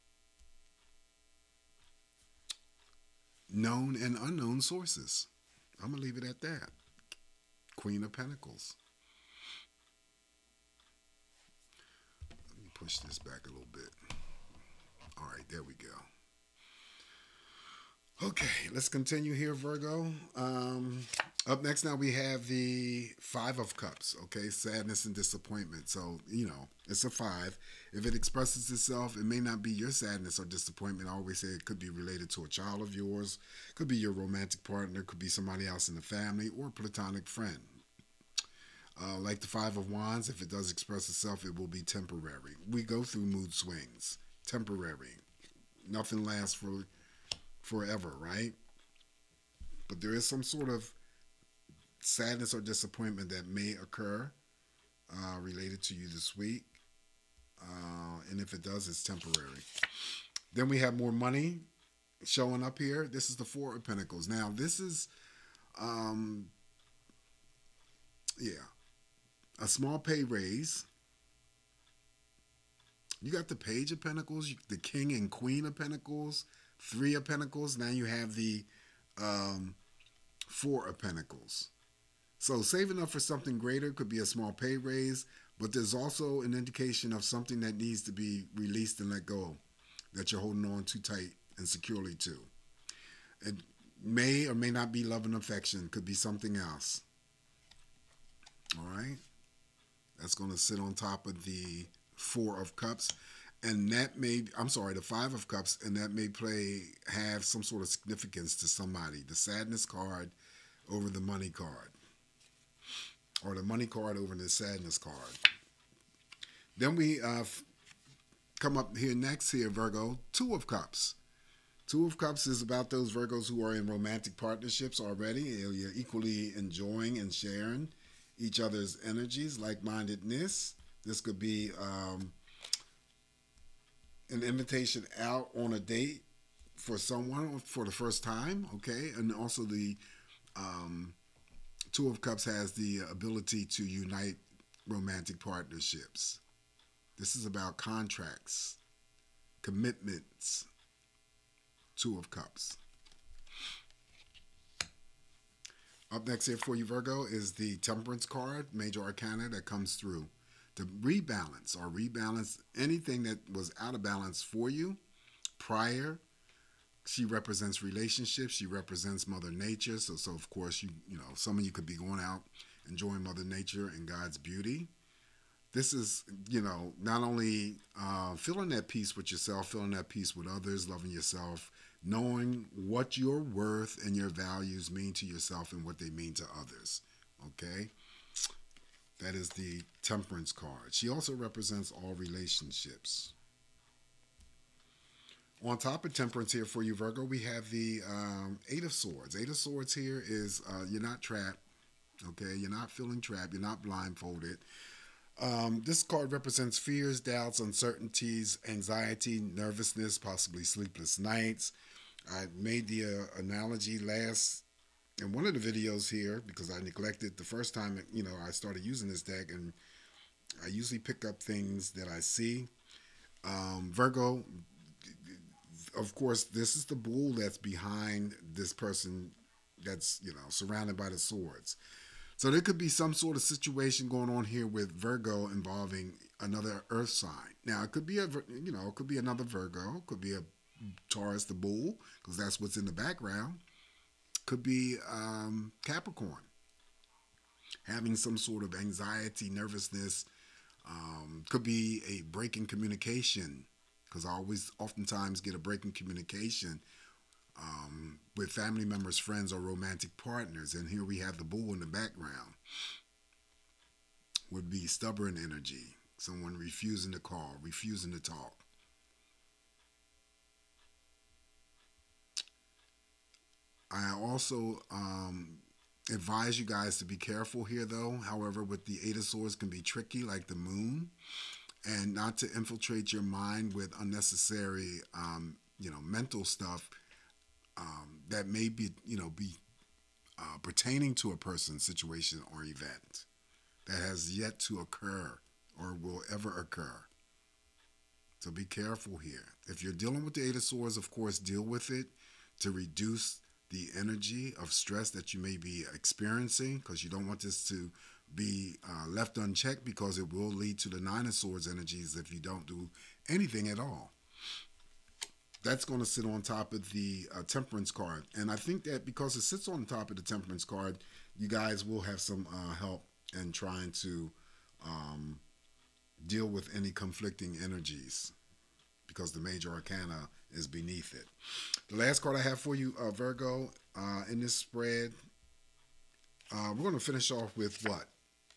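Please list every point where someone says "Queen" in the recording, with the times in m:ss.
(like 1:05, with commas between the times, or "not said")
0:07, 1:15.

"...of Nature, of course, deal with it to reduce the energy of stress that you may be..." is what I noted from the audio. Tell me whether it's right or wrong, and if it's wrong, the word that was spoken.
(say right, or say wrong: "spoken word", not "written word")
wrong: "Swords", not "Nature".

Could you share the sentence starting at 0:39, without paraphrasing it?
Uh, like the Five of Wands, if it does express itself, it will be temporary.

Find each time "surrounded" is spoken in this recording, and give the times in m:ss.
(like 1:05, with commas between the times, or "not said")
3:50.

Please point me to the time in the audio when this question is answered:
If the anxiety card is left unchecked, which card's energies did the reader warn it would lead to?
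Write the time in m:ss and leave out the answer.
5:10.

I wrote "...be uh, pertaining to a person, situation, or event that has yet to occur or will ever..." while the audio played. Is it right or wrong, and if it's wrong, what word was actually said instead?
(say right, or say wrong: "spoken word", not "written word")
right.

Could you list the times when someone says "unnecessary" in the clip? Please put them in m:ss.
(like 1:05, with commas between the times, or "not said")
4:43.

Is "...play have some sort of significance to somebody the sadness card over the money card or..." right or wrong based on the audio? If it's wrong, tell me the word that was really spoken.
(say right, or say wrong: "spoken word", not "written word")
right.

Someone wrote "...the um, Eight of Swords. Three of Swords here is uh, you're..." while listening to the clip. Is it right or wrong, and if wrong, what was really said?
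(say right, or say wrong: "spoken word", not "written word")
wrong: "Eight", not "Three".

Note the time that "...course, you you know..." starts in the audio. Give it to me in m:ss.
2:50.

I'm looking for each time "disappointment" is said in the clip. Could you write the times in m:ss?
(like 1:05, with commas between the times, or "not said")
0:25, 0:30, 0:52.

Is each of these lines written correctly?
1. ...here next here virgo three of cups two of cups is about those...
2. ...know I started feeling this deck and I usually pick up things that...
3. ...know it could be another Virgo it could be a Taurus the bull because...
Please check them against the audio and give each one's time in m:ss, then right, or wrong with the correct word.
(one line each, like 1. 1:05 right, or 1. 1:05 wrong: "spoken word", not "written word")
1. 1:58 wrong: "two", not "three"
2. 3:38 wrong: "using", not "feeling"
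3. 3:58 right.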